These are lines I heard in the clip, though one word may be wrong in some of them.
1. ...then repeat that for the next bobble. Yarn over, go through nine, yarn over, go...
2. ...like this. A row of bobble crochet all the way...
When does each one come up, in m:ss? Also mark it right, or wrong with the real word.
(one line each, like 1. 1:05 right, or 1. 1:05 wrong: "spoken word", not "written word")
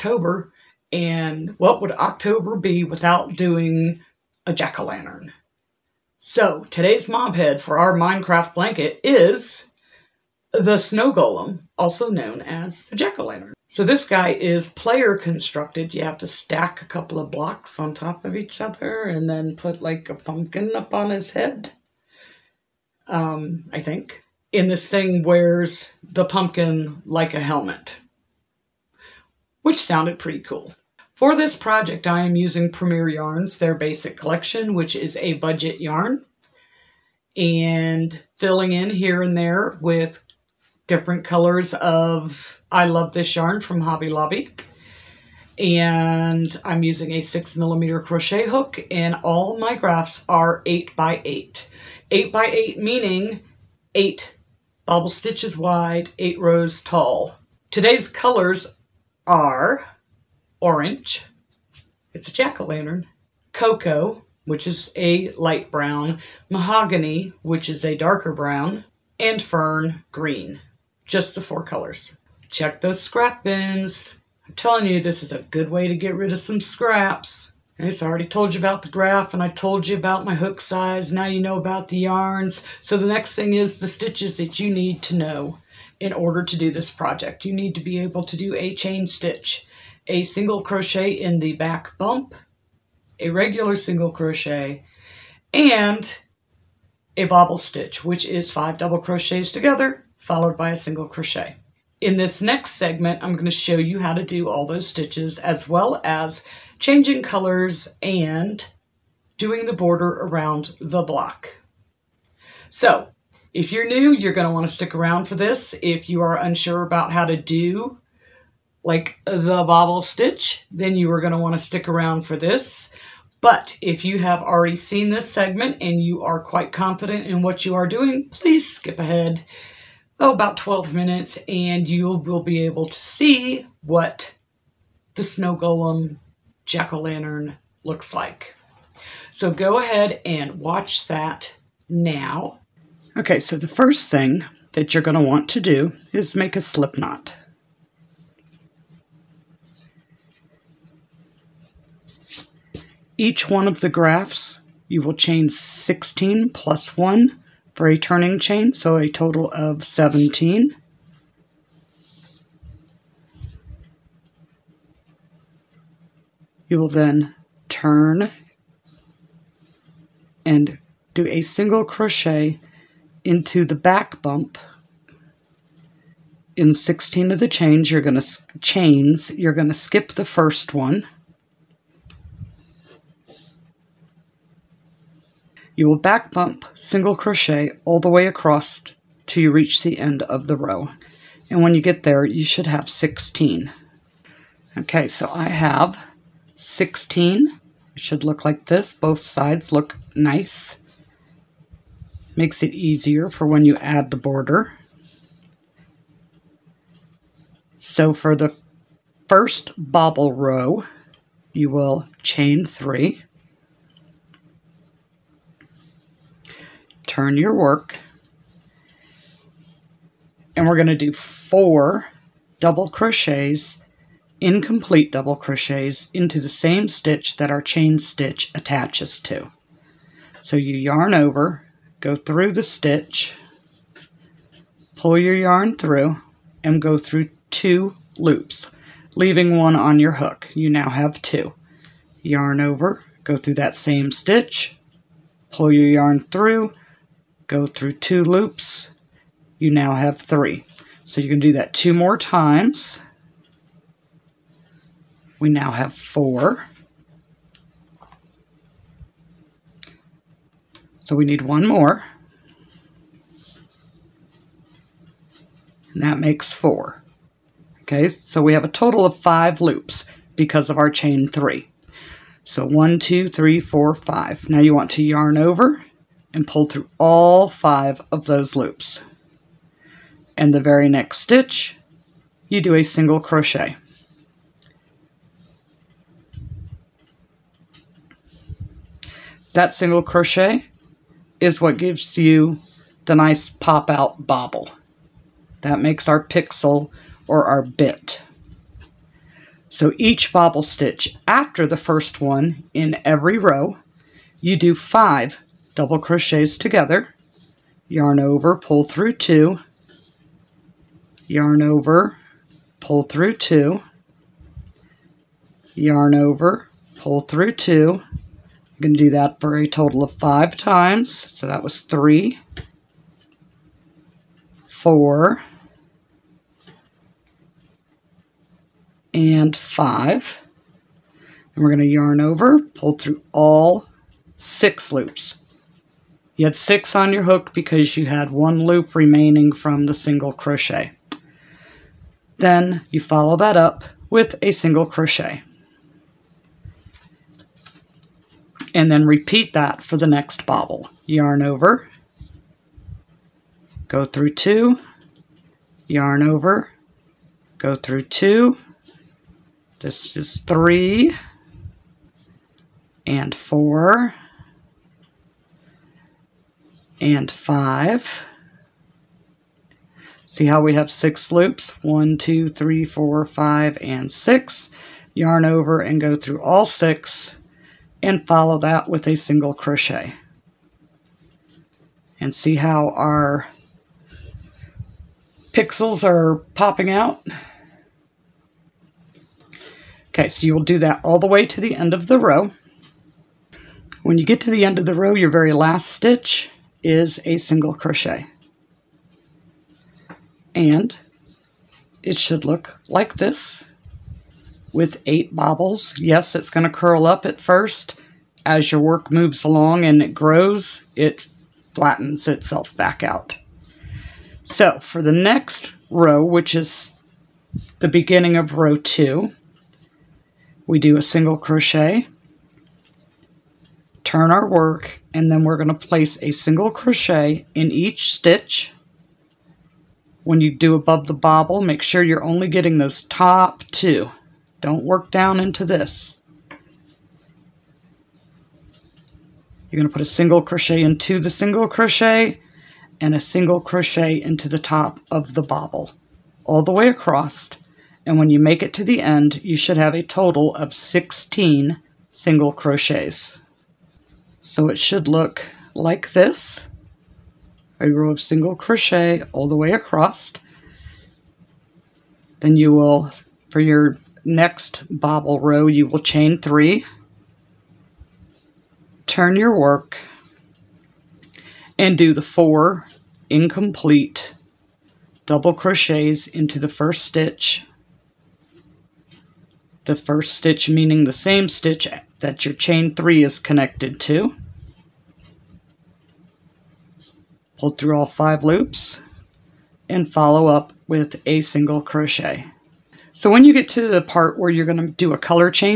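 1. 5:48 wrong: "two", not "nine"
2. 7:35 wrong: "single", not "bobble".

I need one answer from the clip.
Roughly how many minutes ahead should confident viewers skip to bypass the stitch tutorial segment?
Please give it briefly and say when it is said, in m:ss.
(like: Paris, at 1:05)
12, at 2:10.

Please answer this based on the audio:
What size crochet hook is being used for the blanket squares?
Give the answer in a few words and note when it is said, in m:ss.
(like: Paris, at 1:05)
6 millimeter, at 0:47.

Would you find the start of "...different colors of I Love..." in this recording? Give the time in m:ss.
0:40.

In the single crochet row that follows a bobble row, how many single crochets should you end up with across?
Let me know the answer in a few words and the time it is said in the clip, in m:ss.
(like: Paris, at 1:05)
16, at 7:30.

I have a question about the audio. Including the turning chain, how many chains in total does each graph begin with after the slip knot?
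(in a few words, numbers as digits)
17.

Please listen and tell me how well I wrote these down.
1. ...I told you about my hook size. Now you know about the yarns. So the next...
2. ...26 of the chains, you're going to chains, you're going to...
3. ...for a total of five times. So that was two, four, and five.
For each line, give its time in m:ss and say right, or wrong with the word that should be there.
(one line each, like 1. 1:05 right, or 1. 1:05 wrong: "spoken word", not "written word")
1. 1:19 right
2. 2:56 wrong: "16", not "26"
3. 5:19 wrong: "three", not "two".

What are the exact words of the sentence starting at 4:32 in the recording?
So one, two, three, four, five.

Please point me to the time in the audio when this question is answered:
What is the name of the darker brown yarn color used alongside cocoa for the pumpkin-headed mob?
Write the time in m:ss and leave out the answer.
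1:06.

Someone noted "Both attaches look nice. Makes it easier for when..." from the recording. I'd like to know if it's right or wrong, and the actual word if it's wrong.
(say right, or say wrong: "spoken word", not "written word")
wrong: "sides", not "attaches".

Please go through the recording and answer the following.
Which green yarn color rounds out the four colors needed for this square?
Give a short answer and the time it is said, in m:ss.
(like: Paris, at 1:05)
Fern green, at 1:09.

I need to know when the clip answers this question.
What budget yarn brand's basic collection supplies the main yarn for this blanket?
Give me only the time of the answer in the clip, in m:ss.
0:32.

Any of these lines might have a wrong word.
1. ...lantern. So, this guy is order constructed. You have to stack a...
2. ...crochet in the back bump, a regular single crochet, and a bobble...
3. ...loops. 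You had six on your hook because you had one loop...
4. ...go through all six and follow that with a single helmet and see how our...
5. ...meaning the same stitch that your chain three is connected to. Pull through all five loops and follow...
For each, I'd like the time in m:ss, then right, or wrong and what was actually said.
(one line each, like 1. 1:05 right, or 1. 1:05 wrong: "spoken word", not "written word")
1. 0:13 wrong: "player", not "order"
2. 1:30 right
3. 5:34 right
4. 6:15 wrong: "crochet", not "helmet"
5. 8:00 right.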